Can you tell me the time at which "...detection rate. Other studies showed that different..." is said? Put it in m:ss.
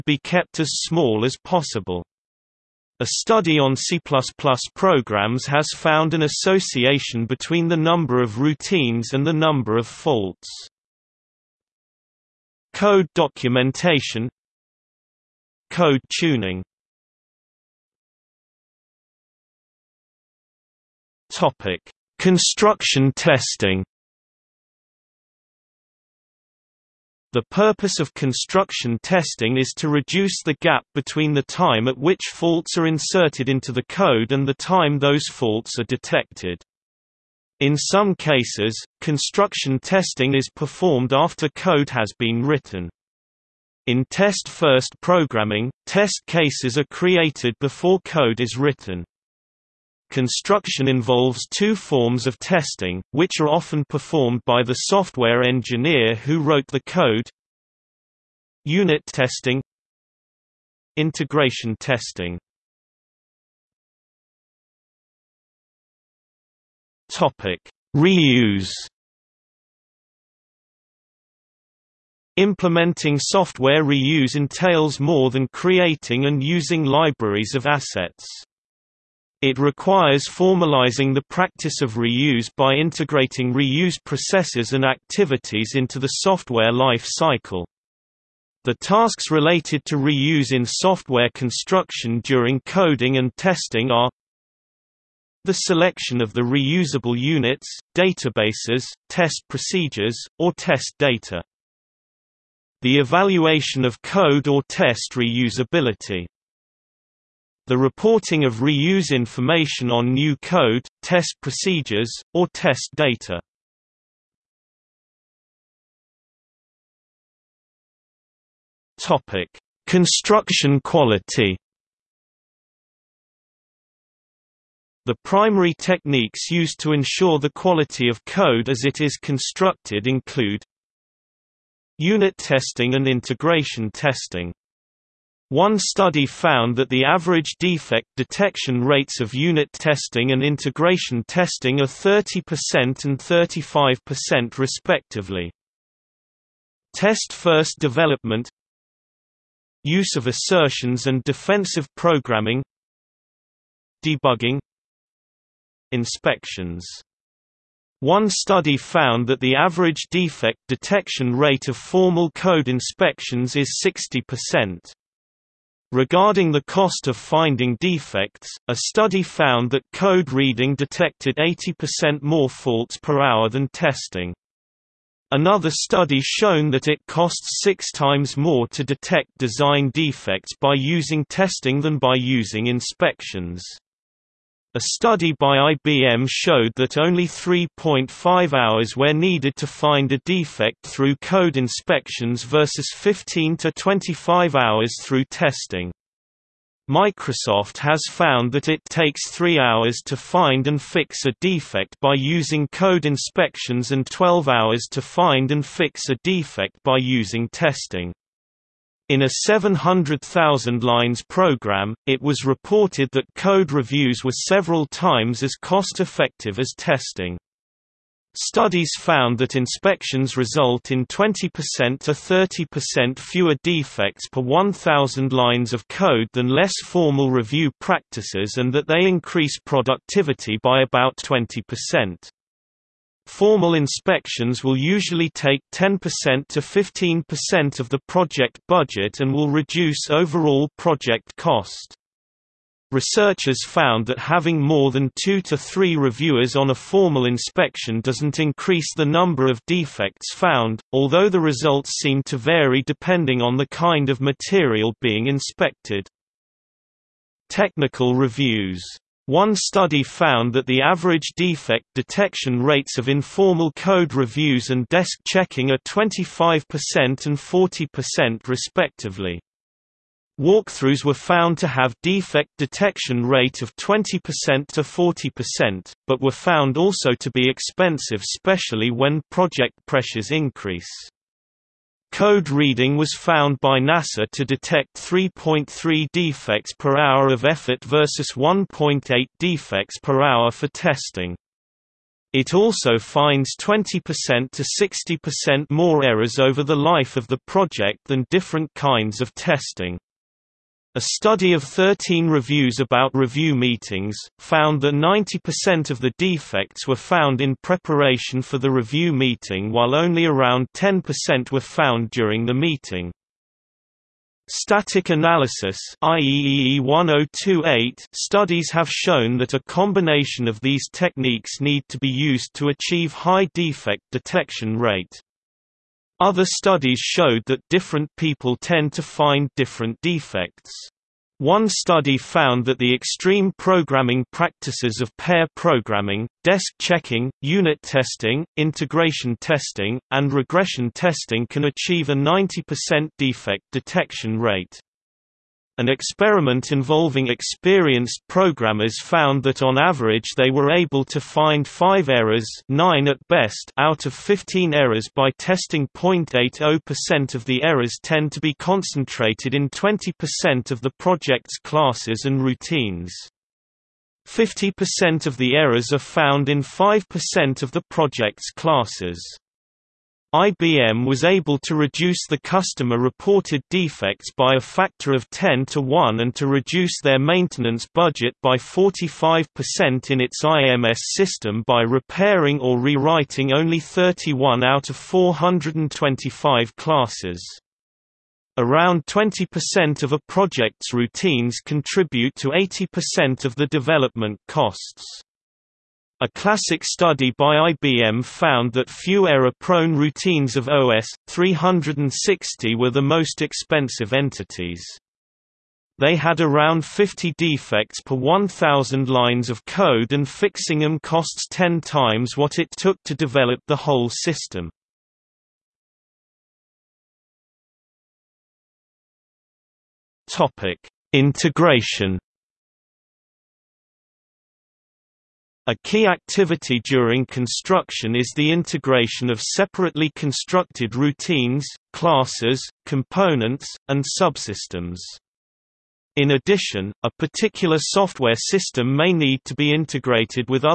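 5:24.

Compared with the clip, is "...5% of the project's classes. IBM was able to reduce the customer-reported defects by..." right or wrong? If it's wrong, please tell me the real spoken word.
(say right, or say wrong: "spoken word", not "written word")
right.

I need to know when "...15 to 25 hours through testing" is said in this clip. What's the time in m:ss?
3:12.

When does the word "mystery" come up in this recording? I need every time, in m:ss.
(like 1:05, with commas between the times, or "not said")
not said.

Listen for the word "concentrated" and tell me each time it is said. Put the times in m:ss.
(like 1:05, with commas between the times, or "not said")
5:58.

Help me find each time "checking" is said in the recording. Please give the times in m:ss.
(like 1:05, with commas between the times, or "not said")
4:25, 5:36.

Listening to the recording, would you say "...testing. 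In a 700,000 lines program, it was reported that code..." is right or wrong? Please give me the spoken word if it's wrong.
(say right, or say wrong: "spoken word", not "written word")
right.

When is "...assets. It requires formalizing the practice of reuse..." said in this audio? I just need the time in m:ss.
1:17.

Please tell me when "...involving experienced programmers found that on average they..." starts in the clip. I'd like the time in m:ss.
5:46.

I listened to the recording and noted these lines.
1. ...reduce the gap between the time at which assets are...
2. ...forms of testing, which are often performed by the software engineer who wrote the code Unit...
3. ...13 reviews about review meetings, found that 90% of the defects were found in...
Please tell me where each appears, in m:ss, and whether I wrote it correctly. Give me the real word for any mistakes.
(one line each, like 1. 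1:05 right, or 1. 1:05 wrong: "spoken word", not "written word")
1. 0:29 wrong: "faults", not "assets"
2. 0:51 right
3. 5:01 right.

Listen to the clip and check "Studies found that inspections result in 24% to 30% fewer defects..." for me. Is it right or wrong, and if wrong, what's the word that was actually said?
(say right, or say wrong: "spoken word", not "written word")
wrong: "20", not "24".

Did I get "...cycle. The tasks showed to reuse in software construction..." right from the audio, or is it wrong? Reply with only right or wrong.
wrong.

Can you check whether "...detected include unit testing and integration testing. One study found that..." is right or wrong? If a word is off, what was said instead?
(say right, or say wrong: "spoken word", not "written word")
wrong: "constructed", not "detected".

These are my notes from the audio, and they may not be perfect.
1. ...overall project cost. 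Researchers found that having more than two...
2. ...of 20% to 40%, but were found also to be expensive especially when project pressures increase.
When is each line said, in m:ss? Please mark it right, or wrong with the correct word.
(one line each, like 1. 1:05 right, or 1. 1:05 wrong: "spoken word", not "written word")
1. 4:00 right
2. 4:33 right.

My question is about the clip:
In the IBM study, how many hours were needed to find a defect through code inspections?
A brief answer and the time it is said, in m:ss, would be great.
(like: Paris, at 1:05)
3.5 hours, at 3:07.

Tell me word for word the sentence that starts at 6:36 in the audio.
A classic study by IBM found that few error-prone routines of OS 360 were the most expensive entities.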